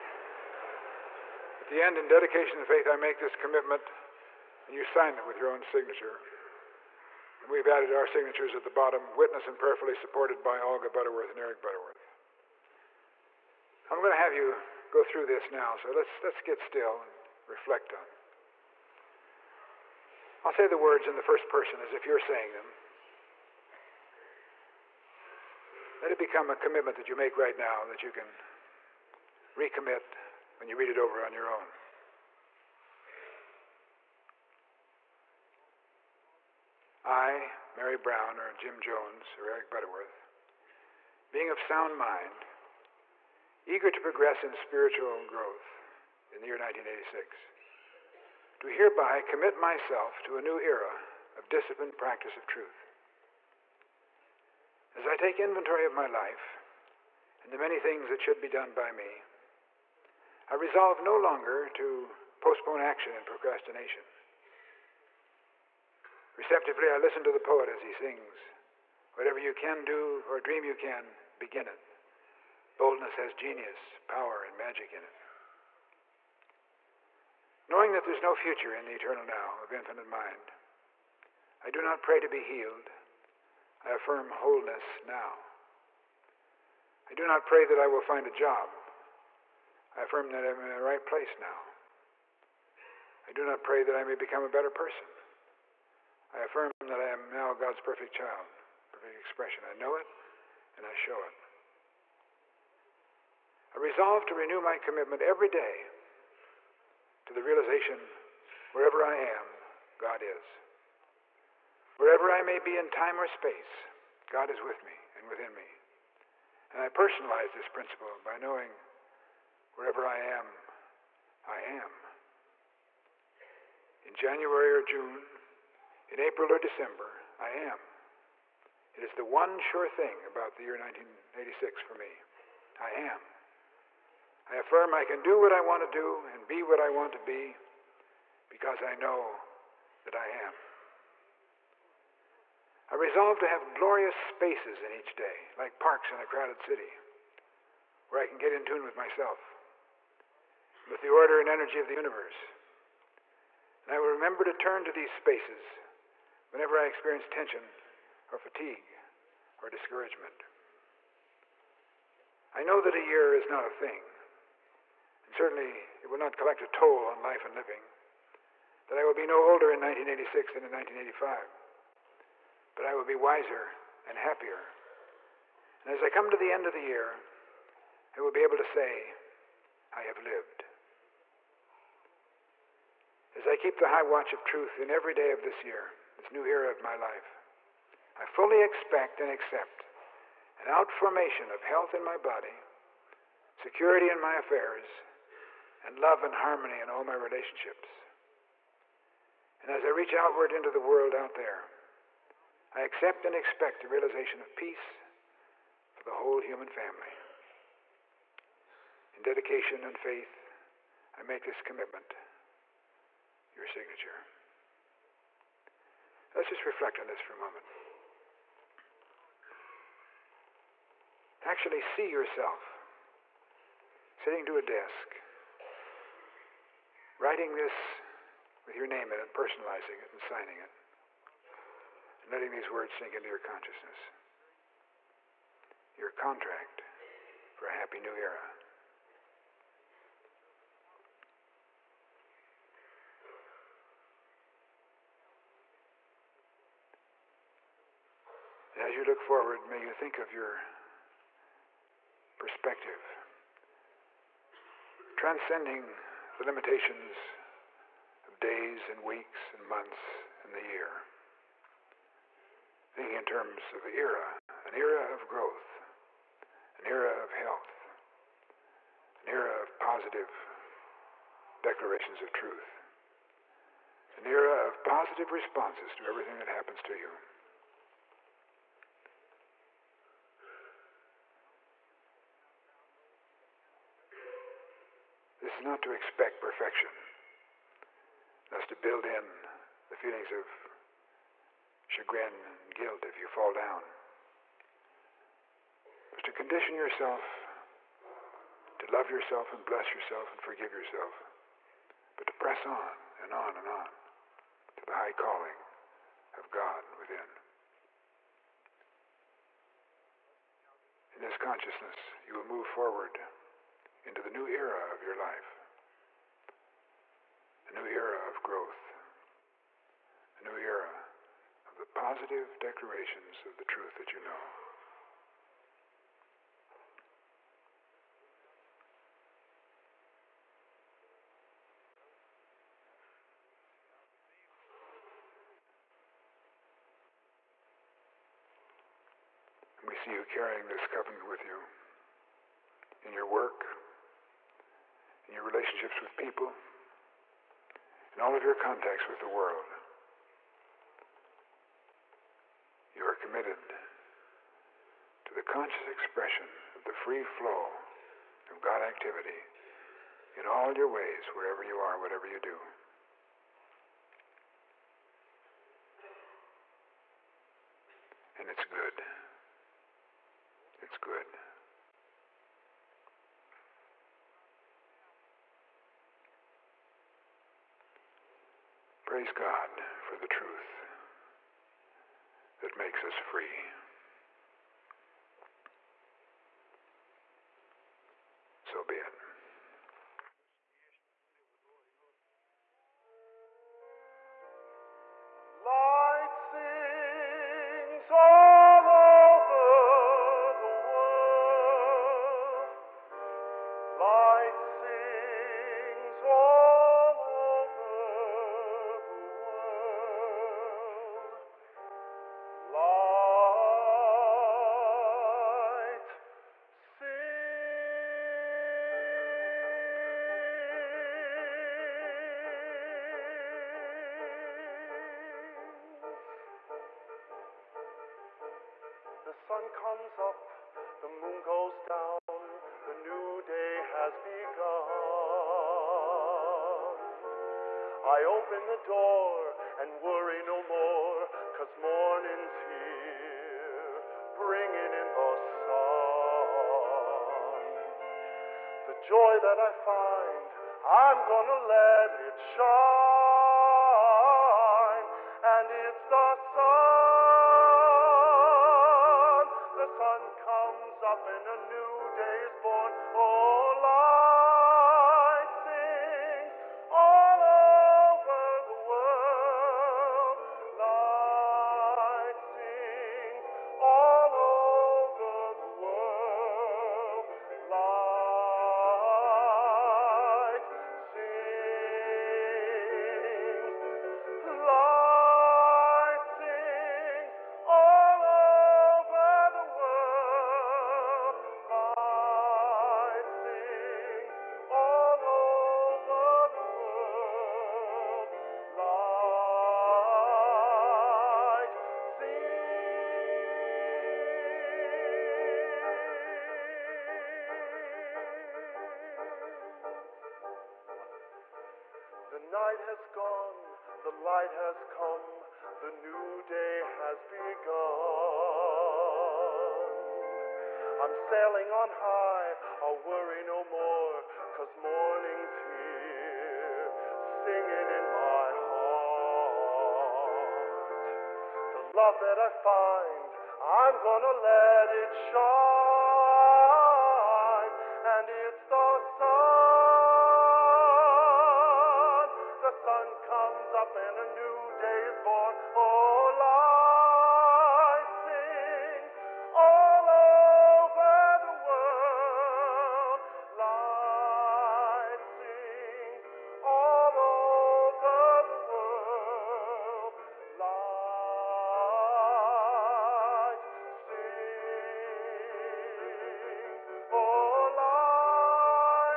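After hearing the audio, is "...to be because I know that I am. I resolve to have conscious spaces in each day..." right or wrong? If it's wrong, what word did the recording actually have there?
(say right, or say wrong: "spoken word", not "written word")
wrong: "glorious", not "conscious".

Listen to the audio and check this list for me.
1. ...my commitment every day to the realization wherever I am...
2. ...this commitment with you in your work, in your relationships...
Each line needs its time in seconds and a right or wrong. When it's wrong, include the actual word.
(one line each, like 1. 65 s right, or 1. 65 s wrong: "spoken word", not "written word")
1. 104 s right
2. 340 s wrong: "covenant", not "commitment".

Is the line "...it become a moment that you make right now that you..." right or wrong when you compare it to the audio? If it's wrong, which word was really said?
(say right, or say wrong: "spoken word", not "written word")
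wrong: "commitment", not "moment".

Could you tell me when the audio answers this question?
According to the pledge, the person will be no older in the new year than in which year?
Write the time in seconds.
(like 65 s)
170 s.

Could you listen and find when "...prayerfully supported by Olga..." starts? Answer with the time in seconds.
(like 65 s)
9 s.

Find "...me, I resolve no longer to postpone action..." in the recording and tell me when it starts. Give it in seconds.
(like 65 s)
58 s.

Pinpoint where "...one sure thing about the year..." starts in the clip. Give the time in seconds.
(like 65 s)
129 s.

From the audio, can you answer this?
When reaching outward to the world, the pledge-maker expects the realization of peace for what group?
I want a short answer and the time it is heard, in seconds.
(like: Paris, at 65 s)
the whole human family, at 206 s.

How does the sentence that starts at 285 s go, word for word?
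This is not to expect perfection.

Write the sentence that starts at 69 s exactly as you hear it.
Whatever you can do or dream you can, begin it.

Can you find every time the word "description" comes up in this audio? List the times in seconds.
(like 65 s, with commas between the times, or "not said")
not said.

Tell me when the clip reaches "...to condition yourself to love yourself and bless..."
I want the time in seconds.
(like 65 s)
296 s.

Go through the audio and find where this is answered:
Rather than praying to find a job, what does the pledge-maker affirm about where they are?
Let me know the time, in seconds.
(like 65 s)
90 s.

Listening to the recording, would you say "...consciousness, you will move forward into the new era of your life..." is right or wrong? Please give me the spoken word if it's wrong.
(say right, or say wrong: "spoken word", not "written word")
right.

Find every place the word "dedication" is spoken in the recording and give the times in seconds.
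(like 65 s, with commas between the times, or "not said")
2 s, 209 s.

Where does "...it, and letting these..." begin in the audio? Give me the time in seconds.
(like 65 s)
230 s.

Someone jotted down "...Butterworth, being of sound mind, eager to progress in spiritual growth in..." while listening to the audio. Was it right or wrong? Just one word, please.
right.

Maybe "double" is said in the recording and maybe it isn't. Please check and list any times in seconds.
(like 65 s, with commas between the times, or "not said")
not said.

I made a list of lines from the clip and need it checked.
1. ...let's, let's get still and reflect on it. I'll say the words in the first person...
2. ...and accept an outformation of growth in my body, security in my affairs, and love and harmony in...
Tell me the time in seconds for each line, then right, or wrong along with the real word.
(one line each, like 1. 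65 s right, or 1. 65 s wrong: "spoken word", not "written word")
1. 15 s right
2. 189 s wrong: "health", not "growth".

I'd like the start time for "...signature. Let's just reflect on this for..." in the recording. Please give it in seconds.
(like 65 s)
213 s.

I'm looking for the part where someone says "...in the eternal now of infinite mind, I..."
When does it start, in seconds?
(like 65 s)
78 s.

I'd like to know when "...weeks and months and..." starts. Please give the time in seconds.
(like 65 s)
259 s.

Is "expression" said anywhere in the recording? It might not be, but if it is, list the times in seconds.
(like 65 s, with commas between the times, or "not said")
99 s, 355 s.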